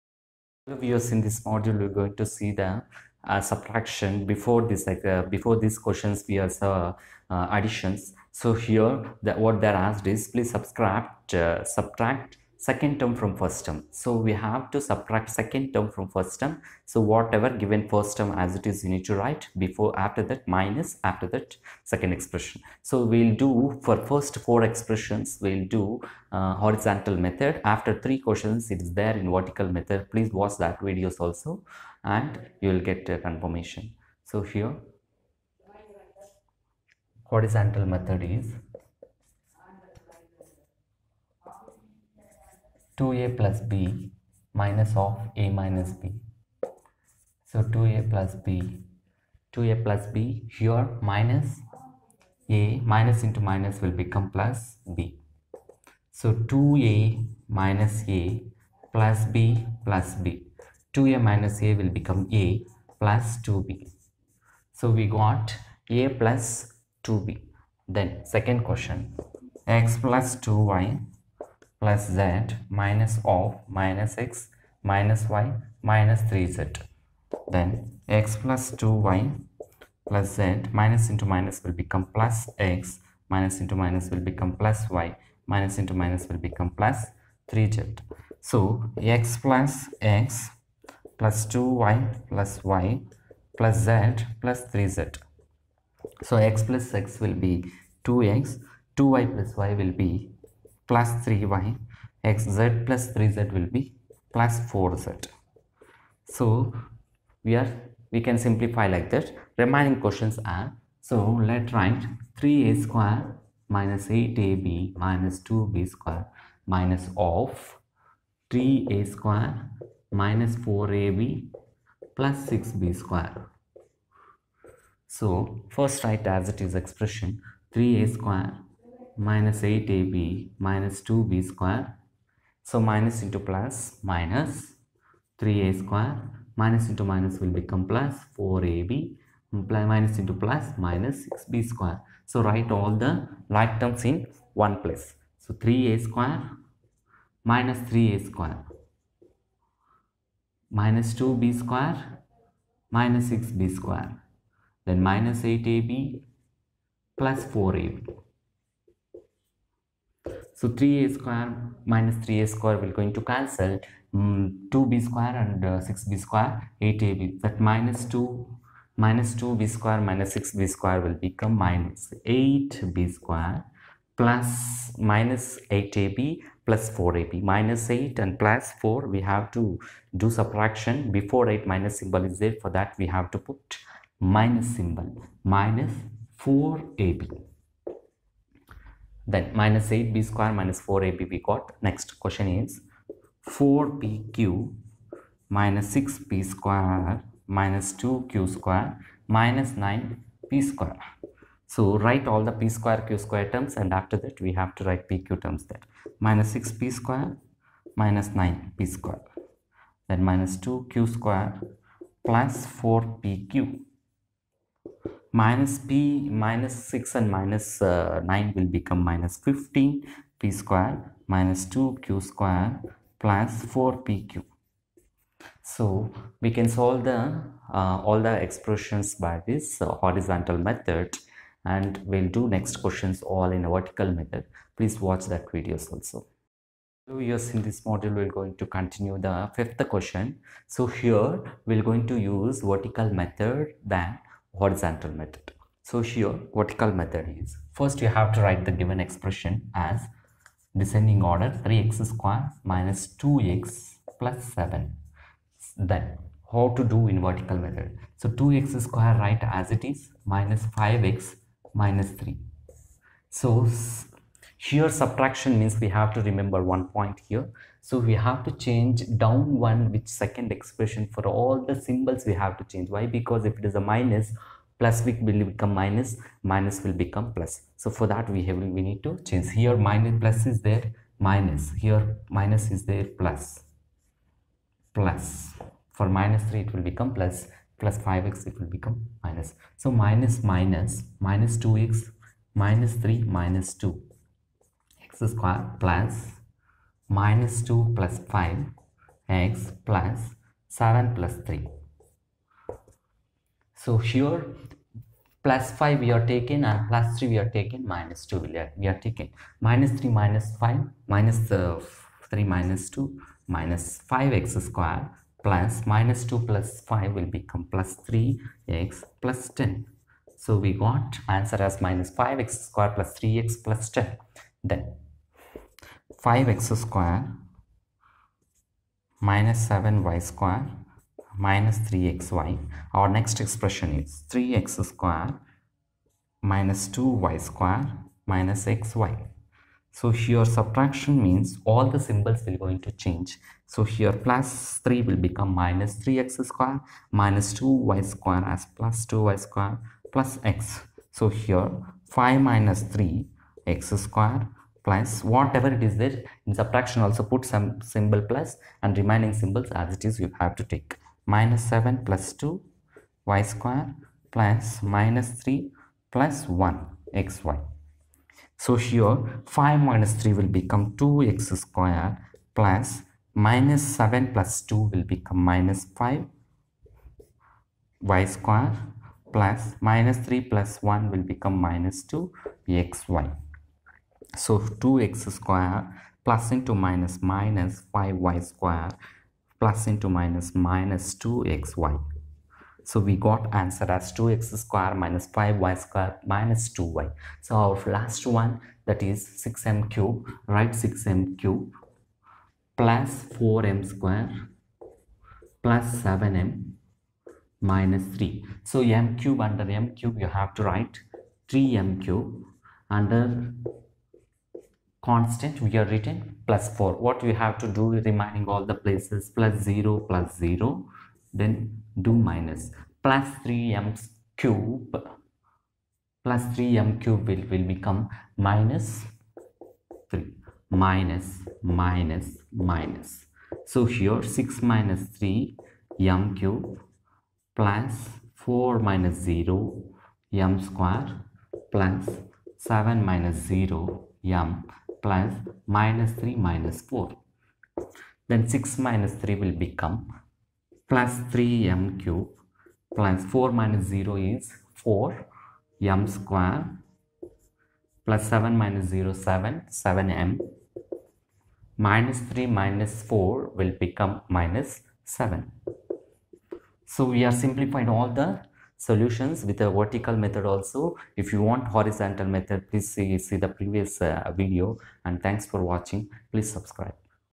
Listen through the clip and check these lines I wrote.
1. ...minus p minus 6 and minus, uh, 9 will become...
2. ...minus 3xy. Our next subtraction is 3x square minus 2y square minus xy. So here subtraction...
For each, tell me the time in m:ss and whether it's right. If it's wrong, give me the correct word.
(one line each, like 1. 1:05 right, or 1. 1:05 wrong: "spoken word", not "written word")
1. 3:35 right
2. 5:31 wrong: "expression", not "subtraction".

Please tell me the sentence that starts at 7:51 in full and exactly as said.
If you want horizontal method, please see, see the previous uh, video and thanks for watching.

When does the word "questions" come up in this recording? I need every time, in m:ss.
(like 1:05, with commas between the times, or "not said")
0:05, 0:28, 1:08, 1:50, 3:12, 3:52, 3:59.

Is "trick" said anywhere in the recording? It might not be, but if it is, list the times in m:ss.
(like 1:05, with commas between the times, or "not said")
not said.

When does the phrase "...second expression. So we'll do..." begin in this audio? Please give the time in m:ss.
0:21.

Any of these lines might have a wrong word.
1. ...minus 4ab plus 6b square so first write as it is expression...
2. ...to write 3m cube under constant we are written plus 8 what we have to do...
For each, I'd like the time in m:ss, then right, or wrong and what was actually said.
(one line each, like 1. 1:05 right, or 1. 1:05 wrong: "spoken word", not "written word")
1. 2:00 right
2. 6:50 wrong: "4", not "8".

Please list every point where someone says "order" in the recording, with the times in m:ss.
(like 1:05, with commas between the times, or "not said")
4:11.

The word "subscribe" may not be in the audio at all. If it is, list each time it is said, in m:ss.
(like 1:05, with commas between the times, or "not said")
7:56.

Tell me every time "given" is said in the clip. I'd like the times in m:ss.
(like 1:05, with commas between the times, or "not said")
0:17, 4:08.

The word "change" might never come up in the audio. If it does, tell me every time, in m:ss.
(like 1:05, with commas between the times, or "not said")
4:28, 4:32, 4:39, 5:42.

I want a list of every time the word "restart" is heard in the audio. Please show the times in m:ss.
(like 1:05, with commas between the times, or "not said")
not said.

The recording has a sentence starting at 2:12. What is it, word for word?
So minus into plus minus 3a square minus into minus will become plus 4ab minus into plus minus 6b square.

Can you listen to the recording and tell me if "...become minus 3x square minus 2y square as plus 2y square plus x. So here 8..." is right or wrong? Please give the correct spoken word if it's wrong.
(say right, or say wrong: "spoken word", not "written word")
wrong: "5", not "8".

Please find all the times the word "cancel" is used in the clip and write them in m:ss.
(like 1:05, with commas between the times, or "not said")
2:43.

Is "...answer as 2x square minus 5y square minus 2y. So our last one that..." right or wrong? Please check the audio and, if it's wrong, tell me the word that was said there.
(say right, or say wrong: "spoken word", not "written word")
right.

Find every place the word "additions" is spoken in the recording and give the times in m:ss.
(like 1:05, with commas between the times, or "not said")
0:07.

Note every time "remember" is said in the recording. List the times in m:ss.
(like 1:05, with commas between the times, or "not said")
4:26.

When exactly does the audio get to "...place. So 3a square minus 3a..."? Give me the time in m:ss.
2:24.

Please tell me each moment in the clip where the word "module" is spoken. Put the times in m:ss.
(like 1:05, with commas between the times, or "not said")
0:01, 3:57.